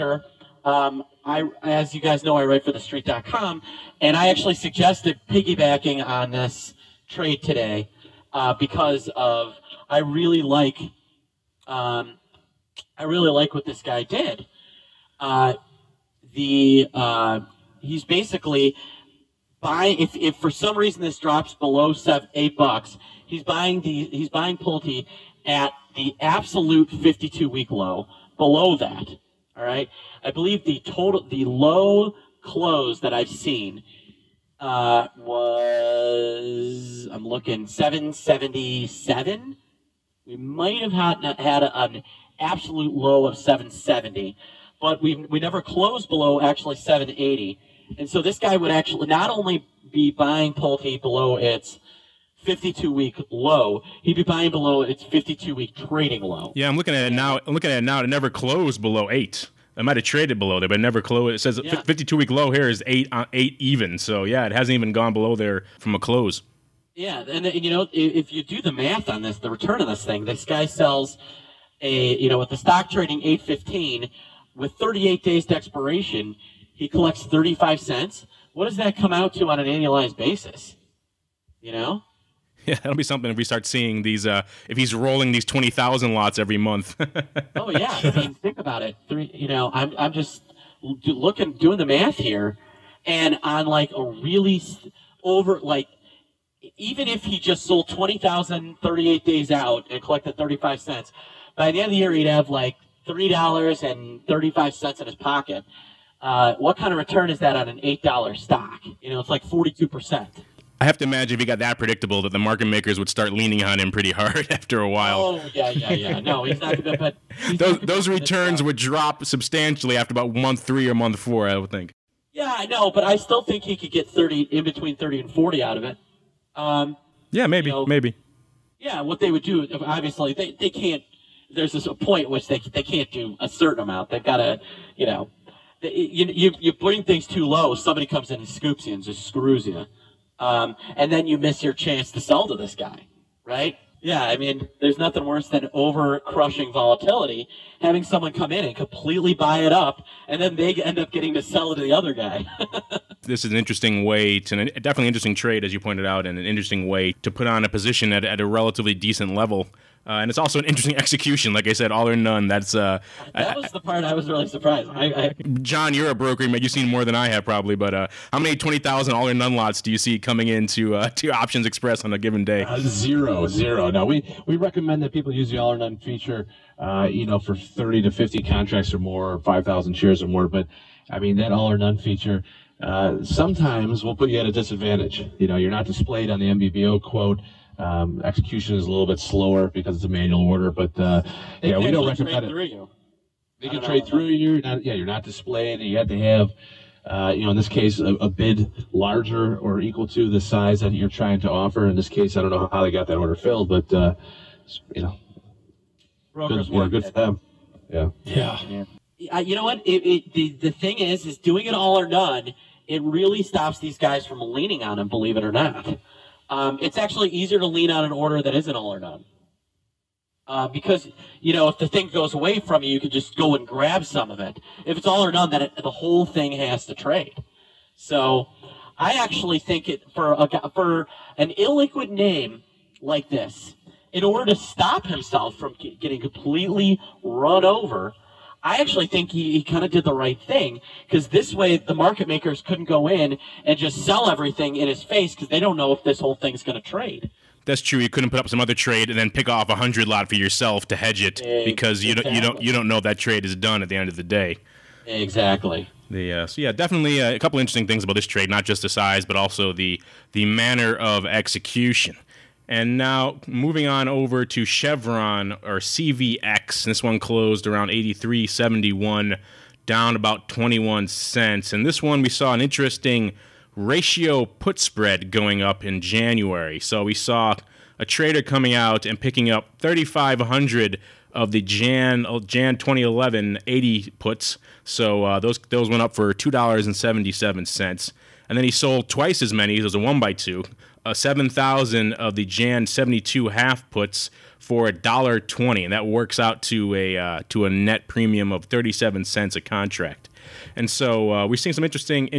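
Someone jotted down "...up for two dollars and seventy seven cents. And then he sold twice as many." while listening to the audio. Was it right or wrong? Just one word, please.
right.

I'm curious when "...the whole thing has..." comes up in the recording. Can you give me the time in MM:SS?
03:45.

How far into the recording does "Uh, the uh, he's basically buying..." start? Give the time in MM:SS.
00:15.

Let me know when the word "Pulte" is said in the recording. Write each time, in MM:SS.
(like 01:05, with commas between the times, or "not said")
00:24, 00:50.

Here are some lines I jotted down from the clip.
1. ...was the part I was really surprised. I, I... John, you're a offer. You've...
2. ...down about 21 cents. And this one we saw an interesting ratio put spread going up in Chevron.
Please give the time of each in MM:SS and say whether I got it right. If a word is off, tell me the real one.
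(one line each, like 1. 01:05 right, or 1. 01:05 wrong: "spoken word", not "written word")
1. 02:43 wrong: "broker", not "offer"
2. 04:29 wrong: "January", not "Chevron".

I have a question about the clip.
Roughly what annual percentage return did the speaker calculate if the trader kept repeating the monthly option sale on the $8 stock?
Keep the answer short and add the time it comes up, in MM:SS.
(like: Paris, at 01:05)
42%, at 01:49.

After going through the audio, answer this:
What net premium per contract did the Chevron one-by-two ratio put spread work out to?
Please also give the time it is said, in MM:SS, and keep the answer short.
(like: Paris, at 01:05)
37 cents, at 04:58.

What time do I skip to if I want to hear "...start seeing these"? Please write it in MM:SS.
01:23.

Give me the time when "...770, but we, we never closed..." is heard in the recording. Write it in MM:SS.
00:43.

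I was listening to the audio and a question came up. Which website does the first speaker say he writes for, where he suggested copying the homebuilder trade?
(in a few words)
TheStreet.com.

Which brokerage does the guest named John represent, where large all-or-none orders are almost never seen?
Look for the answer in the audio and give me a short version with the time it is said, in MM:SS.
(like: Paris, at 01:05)
Options Express, at 02:51.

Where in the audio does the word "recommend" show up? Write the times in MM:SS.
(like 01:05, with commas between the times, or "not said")
02:54, 03:12.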